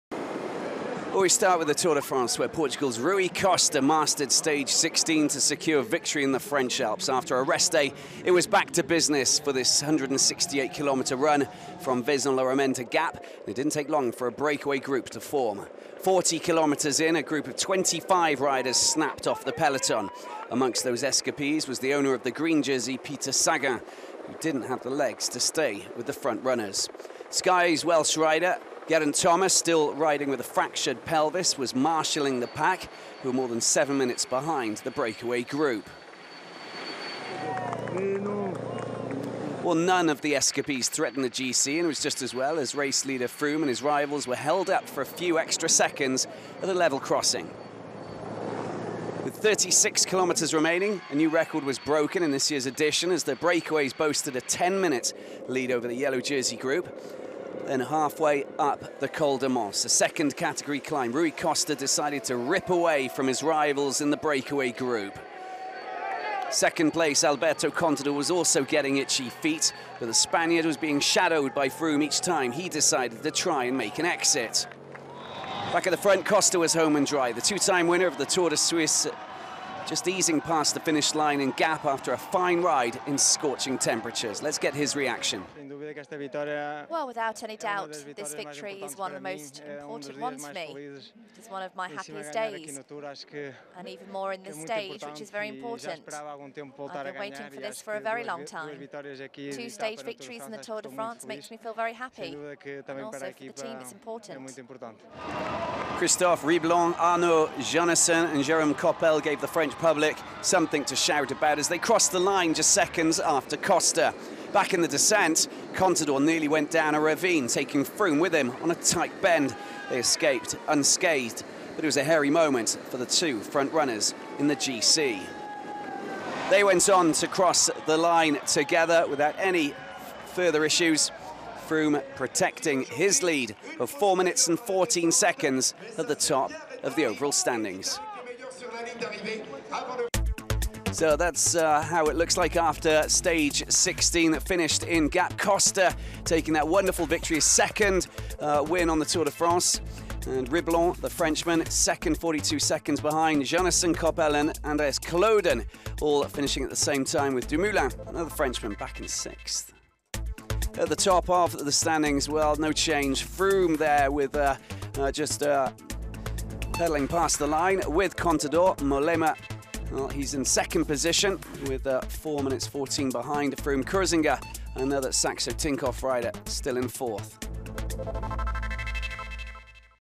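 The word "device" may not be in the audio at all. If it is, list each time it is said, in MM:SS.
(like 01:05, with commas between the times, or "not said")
not said.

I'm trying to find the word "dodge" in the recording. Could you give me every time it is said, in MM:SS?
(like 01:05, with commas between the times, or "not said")
not said.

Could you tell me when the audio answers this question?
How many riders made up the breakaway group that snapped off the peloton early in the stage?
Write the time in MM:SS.
00:17.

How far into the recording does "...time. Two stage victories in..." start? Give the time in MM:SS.
01:38.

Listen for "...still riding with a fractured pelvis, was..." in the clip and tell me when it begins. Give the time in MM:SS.
00:29.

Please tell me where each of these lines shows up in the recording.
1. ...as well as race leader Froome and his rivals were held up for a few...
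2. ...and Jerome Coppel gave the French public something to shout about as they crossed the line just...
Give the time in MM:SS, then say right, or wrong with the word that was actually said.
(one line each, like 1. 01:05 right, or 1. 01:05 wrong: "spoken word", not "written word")
1. 00:42 right
2. 01:48 right.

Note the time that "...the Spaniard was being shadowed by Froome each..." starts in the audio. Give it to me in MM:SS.
01:10.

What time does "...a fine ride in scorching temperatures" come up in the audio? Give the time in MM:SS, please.
01:22.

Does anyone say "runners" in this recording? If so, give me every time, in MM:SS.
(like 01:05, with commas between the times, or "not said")
00:26, 02:03.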